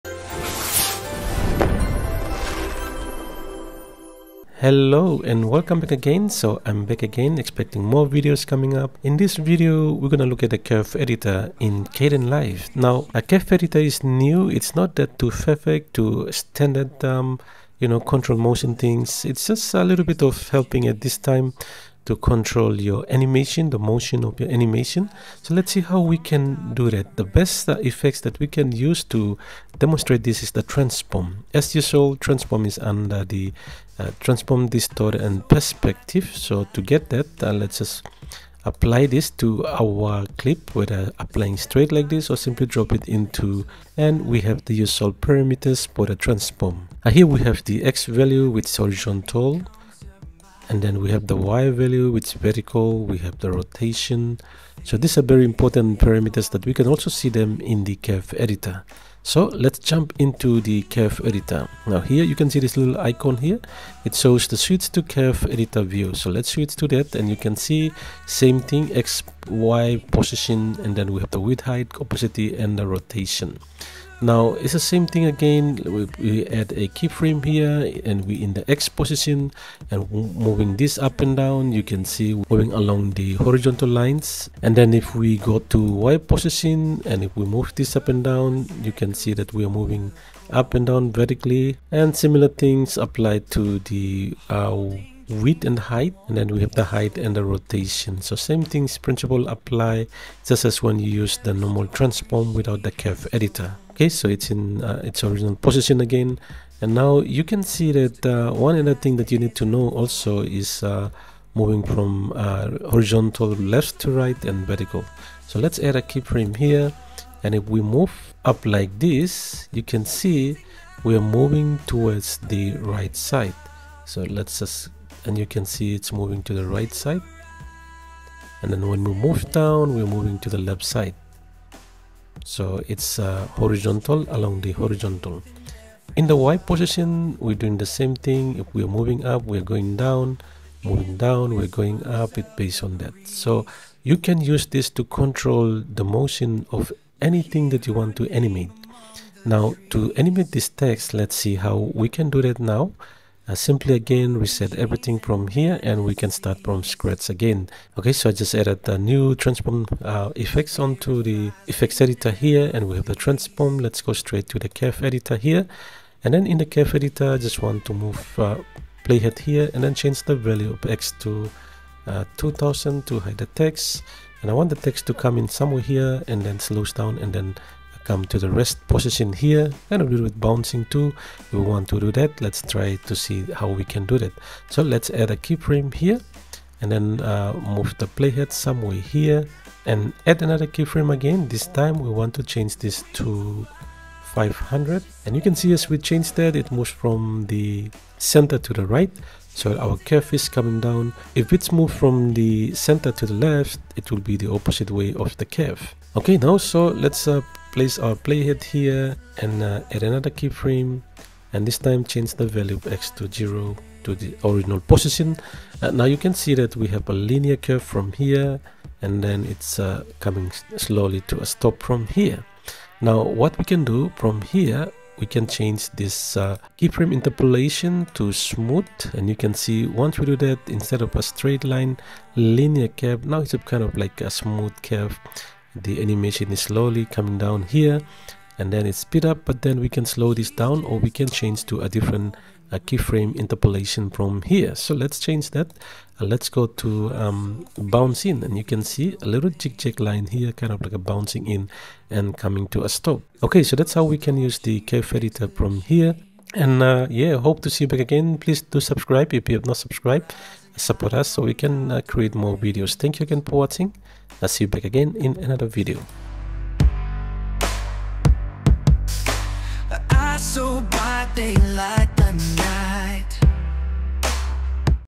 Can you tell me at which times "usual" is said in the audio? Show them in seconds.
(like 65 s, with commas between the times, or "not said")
31 s, 44 s.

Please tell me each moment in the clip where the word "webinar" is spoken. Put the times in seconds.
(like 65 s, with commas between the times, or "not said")
not said.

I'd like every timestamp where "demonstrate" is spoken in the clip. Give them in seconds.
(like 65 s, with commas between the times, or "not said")
29 s.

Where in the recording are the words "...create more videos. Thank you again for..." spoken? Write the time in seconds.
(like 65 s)
262 s.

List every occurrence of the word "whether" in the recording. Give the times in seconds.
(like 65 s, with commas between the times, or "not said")
40 s.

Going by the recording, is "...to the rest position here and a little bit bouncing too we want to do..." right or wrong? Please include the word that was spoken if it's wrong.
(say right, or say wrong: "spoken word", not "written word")
right.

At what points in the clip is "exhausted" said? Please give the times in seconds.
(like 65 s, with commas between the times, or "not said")
not said.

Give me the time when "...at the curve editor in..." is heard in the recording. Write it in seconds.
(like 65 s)
10 s.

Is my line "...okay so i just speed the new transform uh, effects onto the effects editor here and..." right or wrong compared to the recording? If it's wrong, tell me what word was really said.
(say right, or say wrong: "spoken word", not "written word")
wrong: "added", not "speed".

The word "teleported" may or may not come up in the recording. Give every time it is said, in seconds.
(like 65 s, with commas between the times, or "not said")
not said.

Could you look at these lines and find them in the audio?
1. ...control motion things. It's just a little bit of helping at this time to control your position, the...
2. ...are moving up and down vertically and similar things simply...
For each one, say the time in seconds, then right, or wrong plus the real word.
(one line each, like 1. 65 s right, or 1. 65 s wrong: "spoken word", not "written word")
1. 17 s wrong: "animation", not "position"
2. 89 s wrong: "apply", not "simply".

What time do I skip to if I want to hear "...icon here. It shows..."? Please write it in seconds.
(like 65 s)
62 s.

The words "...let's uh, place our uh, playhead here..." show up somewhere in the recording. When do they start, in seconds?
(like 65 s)
207 s.